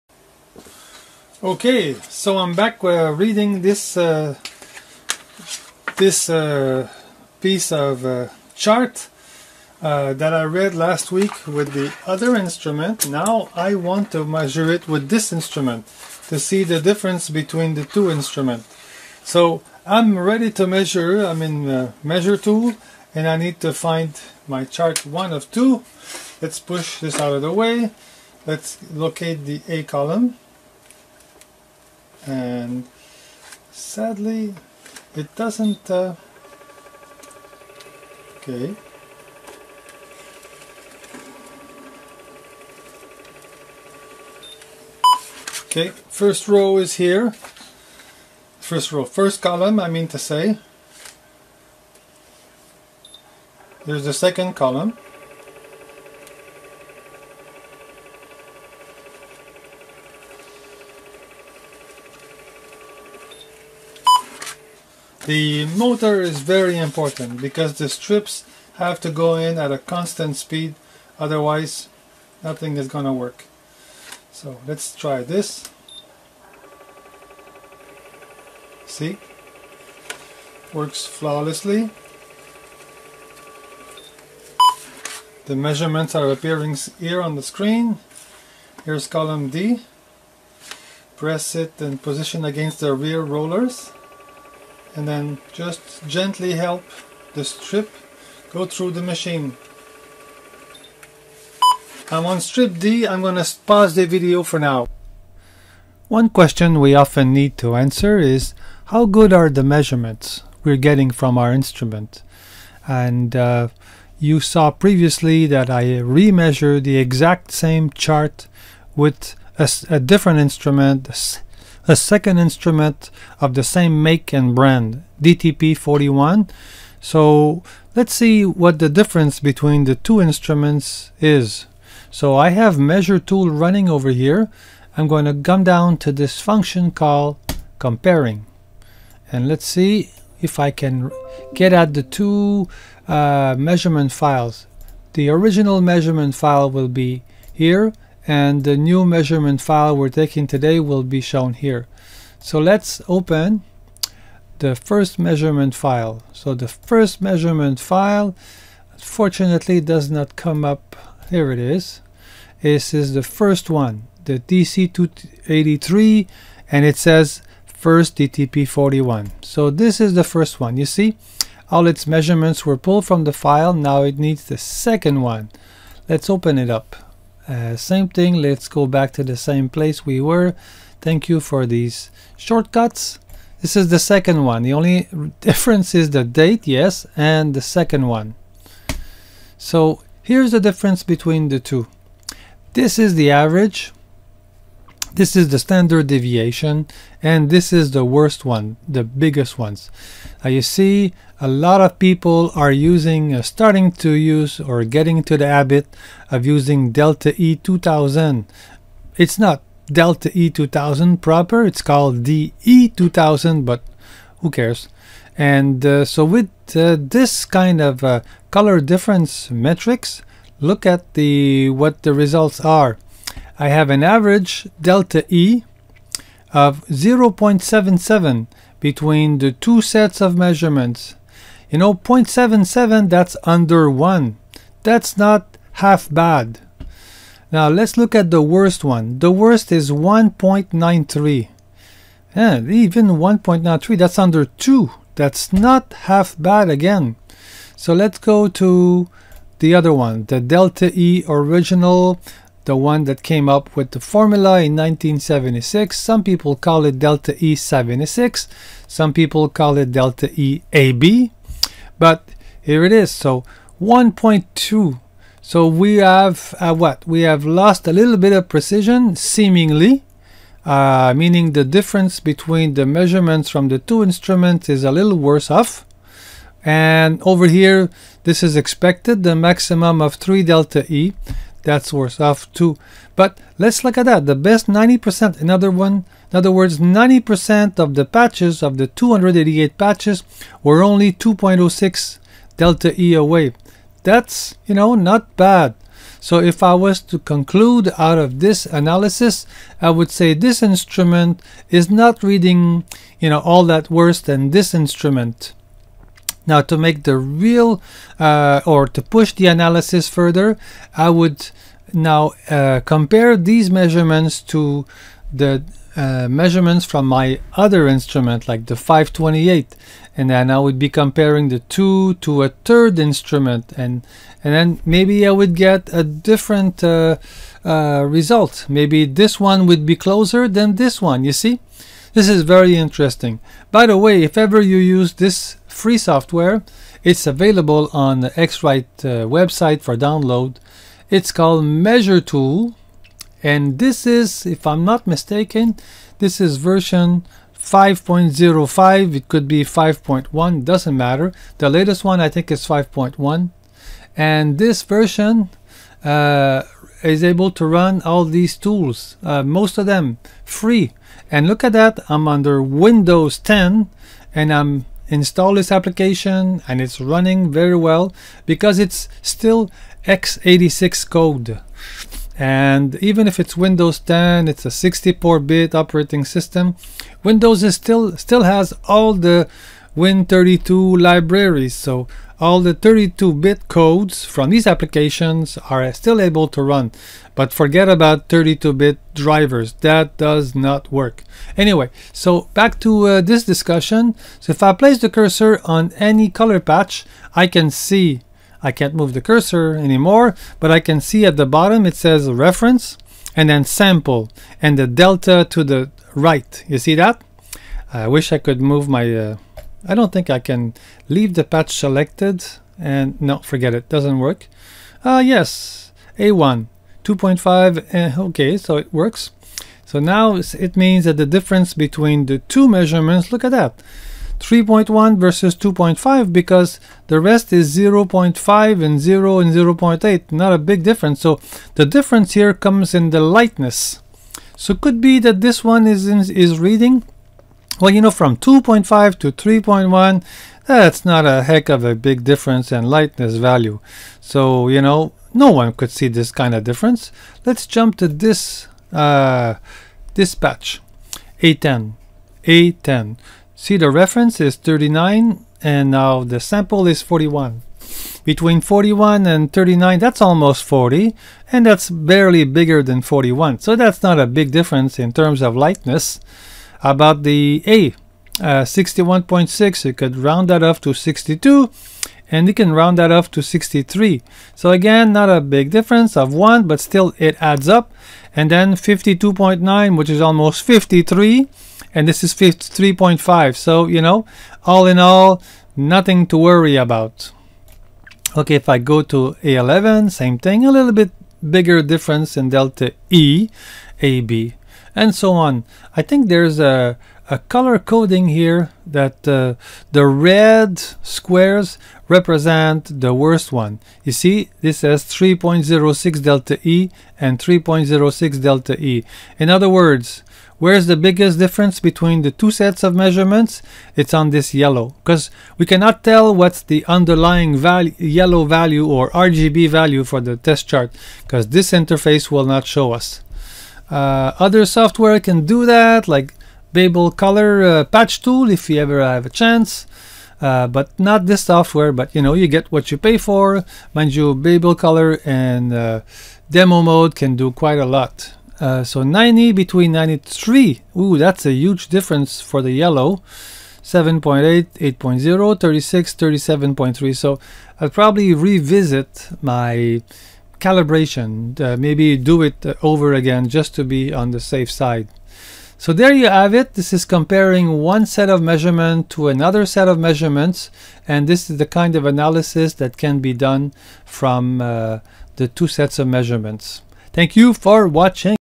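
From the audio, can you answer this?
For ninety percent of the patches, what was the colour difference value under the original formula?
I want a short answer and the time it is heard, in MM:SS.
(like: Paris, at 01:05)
2.06, at 04:51.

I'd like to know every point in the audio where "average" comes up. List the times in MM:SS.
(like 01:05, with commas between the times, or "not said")
03:13, 03:44.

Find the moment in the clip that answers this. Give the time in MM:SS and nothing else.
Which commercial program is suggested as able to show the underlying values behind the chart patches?
08:47.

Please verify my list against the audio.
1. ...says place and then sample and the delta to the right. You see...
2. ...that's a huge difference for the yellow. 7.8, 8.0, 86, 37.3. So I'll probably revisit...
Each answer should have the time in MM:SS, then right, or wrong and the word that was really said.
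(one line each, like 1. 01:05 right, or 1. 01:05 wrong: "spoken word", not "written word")
1. 06:41 wrong: "reference", not "place"
2. 09:01 wrong: "36", not "86".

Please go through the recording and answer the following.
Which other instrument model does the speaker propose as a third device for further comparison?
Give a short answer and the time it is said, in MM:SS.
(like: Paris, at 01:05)
528, at 05:18.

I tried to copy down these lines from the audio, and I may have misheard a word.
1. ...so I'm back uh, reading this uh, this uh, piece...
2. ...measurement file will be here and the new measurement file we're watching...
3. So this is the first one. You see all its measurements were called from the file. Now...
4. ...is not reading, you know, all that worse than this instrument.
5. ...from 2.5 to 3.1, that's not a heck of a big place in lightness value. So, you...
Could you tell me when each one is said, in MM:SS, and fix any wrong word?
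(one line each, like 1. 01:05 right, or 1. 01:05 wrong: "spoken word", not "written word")
1. 00:02 right
2. 02:25 wrong: "taking", not "watching"
3. 02:49 wrong: "pulled", not "called"
4. 05:01 right
5. 07:18 wrong: "difference", not "place".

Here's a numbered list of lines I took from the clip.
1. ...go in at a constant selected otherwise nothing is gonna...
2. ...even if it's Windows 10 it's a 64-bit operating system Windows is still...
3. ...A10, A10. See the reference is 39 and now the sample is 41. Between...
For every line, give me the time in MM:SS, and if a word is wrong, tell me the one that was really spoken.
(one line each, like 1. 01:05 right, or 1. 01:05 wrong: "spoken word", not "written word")
1. 01:09 wrong: "speed", not "selected"
2. 06:12 right
3. 07:31 right.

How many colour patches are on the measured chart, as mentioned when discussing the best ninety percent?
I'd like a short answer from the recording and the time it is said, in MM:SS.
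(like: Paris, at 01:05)
288, at 04:48.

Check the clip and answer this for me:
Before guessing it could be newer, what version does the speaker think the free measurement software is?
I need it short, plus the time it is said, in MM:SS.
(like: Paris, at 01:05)
5.05, at 05:47.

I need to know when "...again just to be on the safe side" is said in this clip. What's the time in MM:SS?
09:13.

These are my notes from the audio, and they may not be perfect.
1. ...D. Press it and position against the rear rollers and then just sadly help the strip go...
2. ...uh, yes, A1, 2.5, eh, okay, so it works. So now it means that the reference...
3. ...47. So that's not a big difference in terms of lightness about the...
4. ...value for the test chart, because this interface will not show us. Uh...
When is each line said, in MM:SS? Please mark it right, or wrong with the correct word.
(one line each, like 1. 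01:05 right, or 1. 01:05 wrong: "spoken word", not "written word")
1. 01:29 wrong: "gently", not "sadly"
2. 06:55 wrong: "difference", not "reference"
3. 07:43 wrong: "41", not "47"
4. 08:39 right.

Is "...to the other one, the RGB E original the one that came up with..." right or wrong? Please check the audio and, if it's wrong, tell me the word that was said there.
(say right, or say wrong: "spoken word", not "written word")
wrong: "Delta", not "RGB".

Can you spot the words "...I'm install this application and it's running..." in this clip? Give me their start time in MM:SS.
06:04.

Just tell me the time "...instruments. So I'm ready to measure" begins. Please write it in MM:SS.
00:18.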